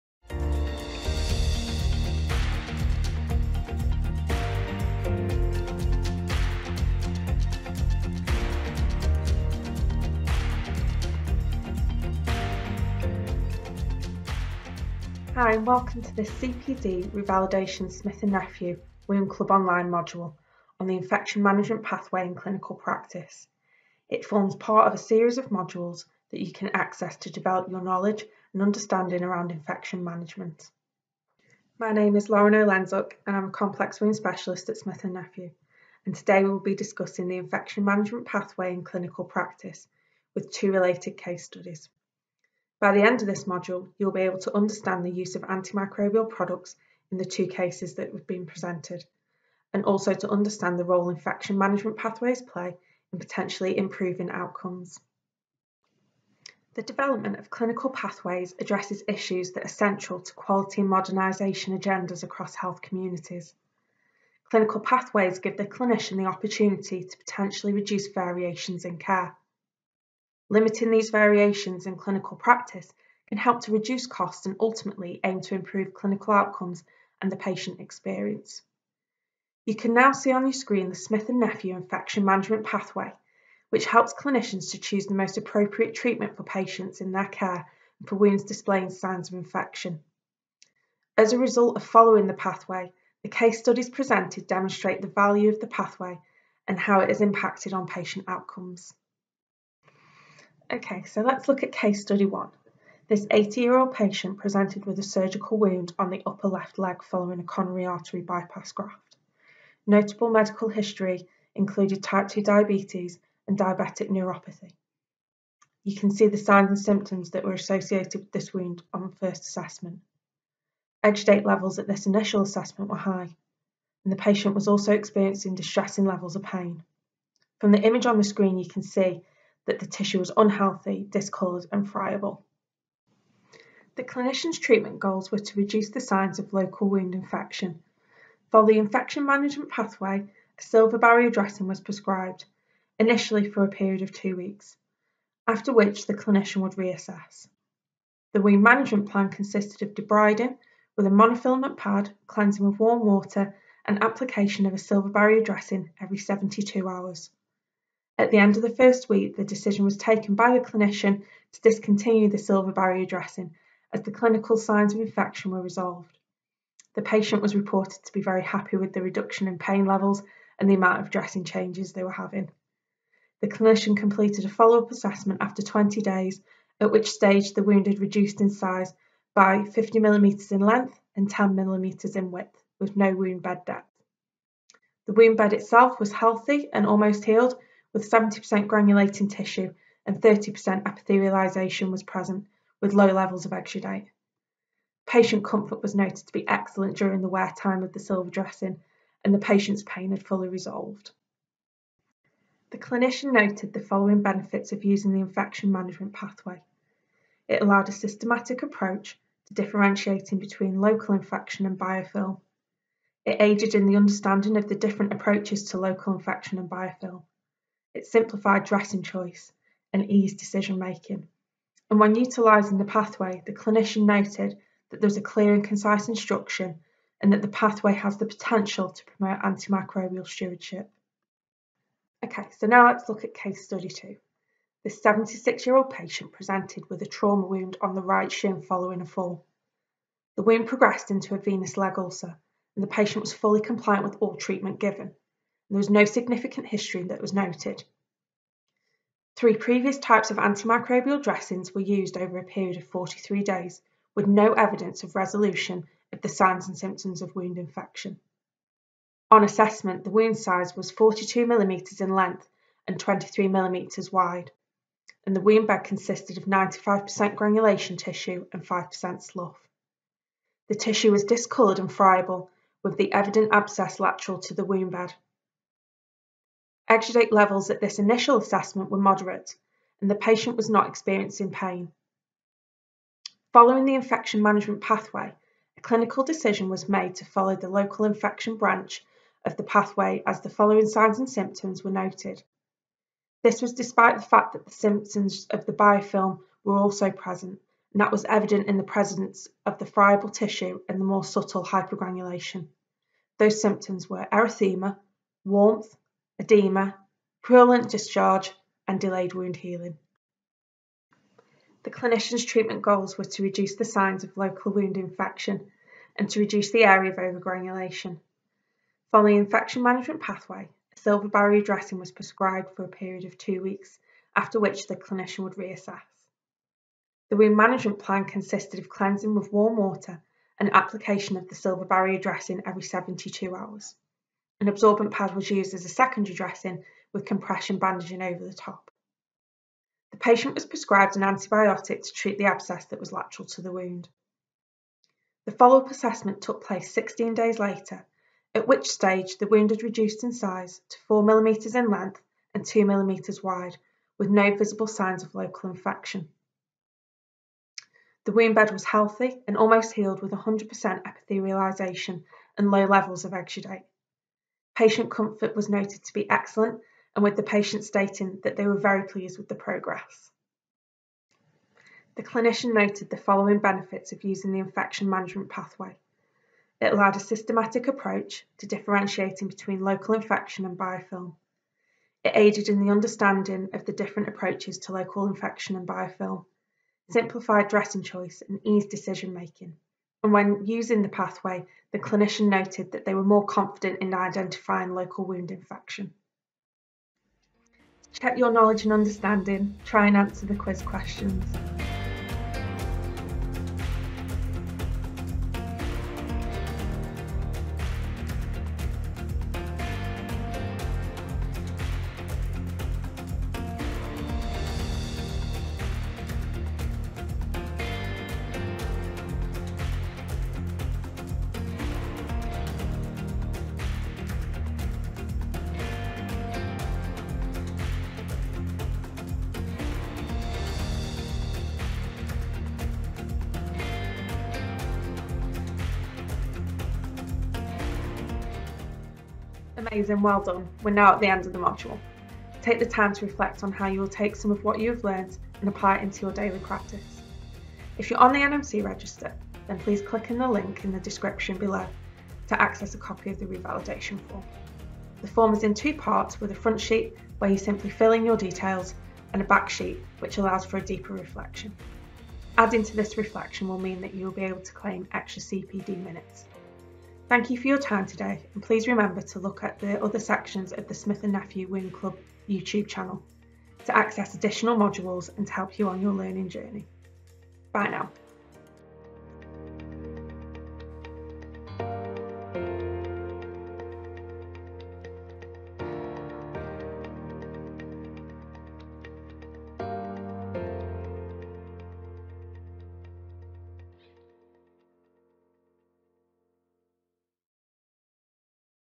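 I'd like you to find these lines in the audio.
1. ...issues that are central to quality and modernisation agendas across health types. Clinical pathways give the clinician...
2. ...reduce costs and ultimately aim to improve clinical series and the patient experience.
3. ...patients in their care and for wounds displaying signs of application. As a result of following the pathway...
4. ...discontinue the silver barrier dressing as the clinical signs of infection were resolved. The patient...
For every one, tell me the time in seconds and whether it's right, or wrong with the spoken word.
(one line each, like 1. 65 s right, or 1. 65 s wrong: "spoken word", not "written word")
1. 59 s wrong: "communities", not "types"
2. 73 s wrong: "outcomes", not "series"
3. 86 s wrong: "infection", not "application"
4. 161 s right.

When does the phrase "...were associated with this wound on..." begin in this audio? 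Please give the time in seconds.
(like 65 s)
117 s.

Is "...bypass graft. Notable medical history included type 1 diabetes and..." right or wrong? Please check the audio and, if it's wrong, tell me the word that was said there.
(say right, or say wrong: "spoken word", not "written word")
wrong: "2", not "1".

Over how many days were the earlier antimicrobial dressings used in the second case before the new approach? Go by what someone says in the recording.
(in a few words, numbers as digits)
43.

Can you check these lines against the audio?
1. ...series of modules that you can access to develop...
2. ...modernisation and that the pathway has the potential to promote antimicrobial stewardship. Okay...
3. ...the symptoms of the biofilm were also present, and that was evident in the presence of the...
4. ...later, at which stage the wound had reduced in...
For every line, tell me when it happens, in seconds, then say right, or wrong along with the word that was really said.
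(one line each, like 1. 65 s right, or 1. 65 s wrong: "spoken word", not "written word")
1. 24 s right
2. 226 s wrong: "instruction", not "modernisation"
3. 294 s right
4. 347 s right.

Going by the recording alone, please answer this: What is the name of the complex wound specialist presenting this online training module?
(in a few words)
Lauren Olenzuk.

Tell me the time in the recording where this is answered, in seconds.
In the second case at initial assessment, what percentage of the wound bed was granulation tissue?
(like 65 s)
266 s.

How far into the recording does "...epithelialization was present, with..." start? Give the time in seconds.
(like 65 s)
190 s.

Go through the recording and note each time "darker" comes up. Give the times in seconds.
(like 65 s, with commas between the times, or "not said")
not said.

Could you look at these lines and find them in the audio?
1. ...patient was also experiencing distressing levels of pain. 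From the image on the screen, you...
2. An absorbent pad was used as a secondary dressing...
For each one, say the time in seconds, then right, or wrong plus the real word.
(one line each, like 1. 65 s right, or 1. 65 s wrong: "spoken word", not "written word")
1. 124 s right
2. 334 s right.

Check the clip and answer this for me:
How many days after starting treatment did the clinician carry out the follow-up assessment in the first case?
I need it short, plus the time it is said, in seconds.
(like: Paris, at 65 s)
20, at 175 s.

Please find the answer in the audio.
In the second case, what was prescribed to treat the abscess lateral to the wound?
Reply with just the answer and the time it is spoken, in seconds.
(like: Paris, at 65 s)
an antibiotic, at 341 s.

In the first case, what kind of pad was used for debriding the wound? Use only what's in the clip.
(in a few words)
monofilament pad.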